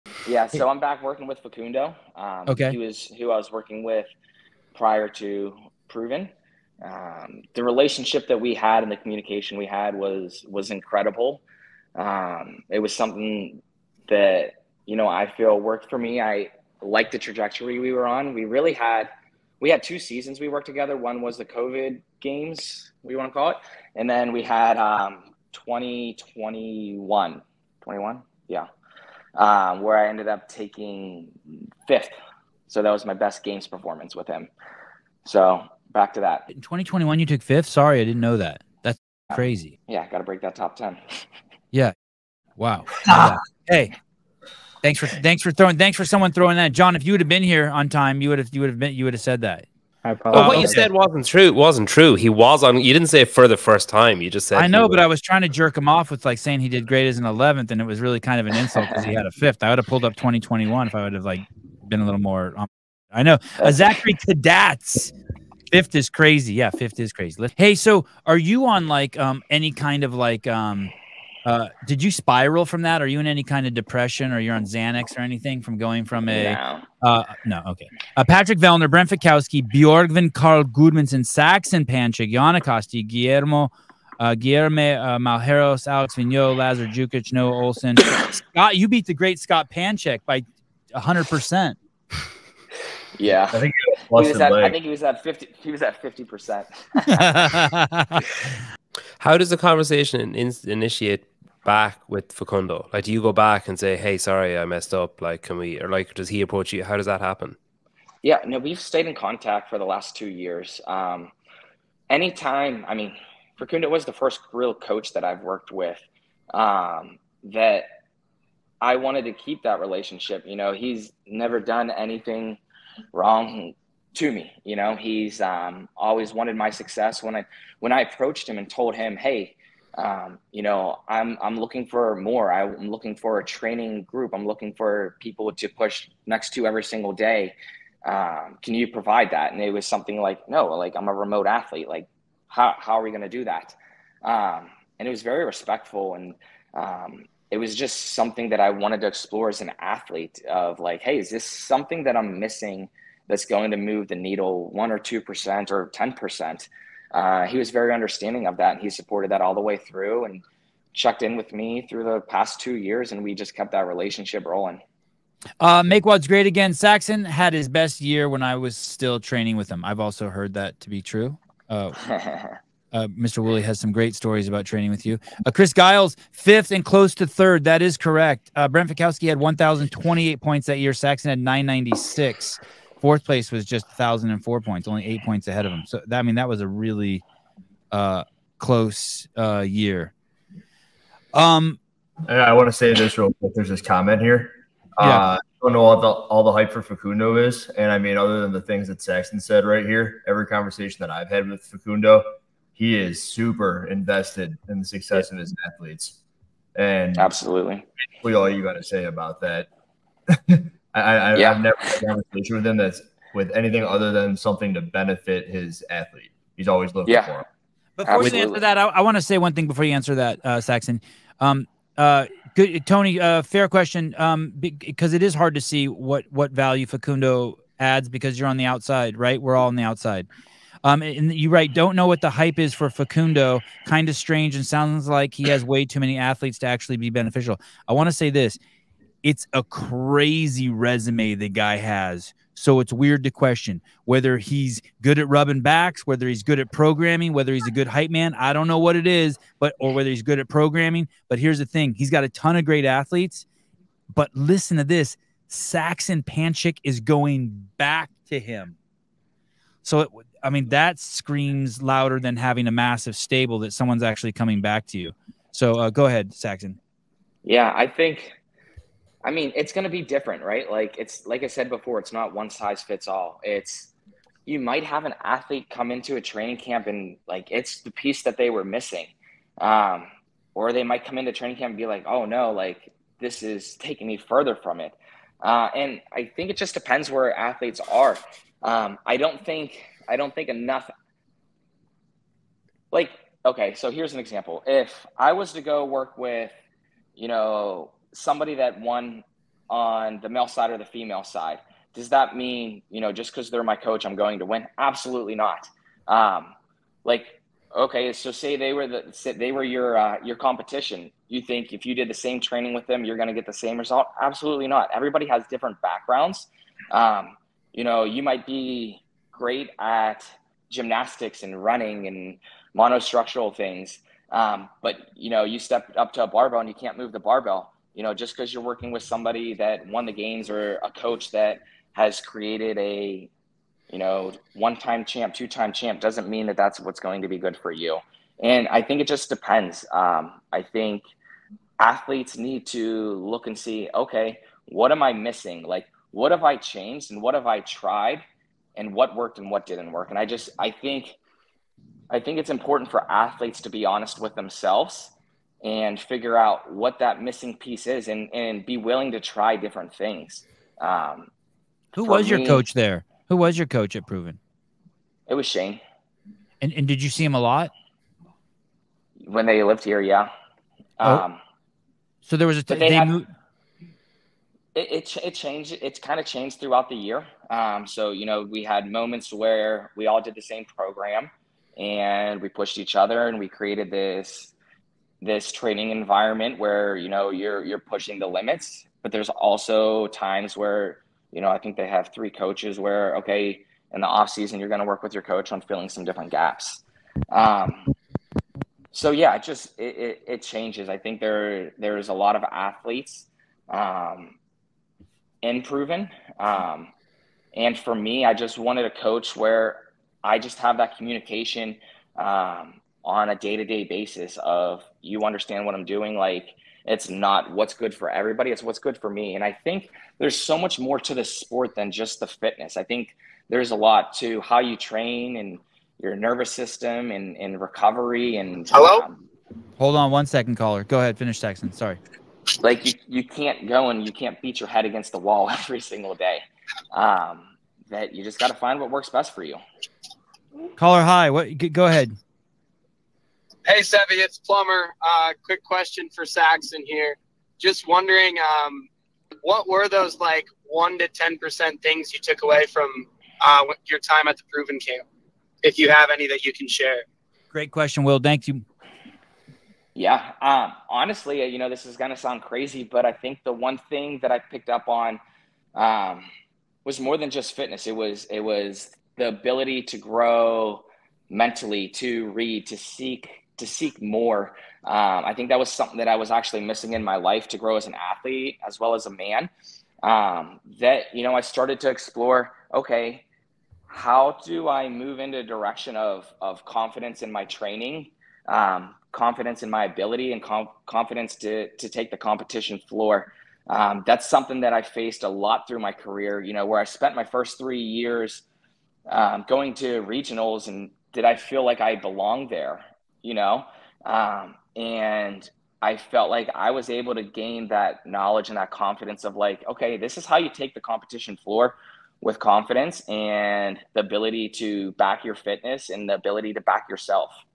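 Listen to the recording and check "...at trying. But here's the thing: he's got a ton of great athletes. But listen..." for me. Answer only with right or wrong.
wrong.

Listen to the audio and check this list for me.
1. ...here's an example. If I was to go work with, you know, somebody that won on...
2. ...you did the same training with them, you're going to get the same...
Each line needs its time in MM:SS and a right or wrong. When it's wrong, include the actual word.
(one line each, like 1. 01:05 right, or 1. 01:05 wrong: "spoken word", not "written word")
1. 04:53 right
2. 05:11 right.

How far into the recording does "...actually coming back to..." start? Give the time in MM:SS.
04:24.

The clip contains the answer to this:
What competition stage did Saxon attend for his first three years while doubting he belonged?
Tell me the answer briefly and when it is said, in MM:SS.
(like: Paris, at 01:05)
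regionals, at 08:20.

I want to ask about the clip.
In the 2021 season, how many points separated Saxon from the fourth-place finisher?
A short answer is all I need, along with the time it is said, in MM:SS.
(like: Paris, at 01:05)
8, at 03:05.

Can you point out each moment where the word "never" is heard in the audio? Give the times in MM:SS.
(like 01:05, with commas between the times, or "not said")
02:01, 03:31.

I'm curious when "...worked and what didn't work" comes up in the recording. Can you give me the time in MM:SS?
05:49.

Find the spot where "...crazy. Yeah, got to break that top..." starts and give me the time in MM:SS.
00:39.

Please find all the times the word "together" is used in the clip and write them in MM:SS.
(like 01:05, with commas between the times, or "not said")
00:20.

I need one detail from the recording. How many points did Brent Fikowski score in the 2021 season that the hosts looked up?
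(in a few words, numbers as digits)
1028.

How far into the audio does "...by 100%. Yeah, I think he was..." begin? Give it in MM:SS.
01:30.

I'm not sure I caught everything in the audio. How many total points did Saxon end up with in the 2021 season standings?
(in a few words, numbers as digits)
996.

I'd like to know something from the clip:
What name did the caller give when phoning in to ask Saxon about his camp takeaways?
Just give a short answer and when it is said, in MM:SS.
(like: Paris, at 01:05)
Plumber, at 07:24.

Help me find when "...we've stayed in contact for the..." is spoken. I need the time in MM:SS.
01:48.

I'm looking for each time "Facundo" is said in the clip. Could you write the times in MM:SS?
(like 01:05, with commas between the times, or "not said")
00:01, 01:42, 01:53, 03:16, 03:21, 03:46, 03:52.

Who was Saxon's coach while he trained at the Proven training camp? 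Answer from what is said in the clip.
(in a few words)
Shane.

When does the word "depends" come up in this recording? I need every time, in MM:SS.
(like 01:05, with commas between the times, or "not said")
04:46, 05:39.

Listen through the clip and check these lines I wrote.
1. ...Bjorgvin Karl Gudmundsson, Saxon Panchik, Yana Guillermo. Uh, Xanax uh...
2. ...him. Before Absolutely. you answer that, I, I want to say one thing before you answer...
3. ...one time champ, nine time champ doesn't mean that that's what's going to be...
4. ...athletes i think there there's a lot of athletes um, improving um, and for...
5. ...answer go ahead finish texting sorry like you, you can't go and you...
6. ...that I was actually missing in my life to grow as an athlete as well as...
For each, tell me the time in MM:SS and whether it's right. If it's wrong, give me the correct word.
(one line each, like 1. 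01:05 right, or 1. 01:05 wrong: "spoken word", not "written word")
1. 01:19 wrong: "Guillermo", not "Xanax"
2. 03:37 right
3. 05:34 wrong: "two", not "nine"
4. 06:40 wrong: "changes", not "athletes"
5. 07:10 wrong: "caller", not "answer"
6. 07:55 right.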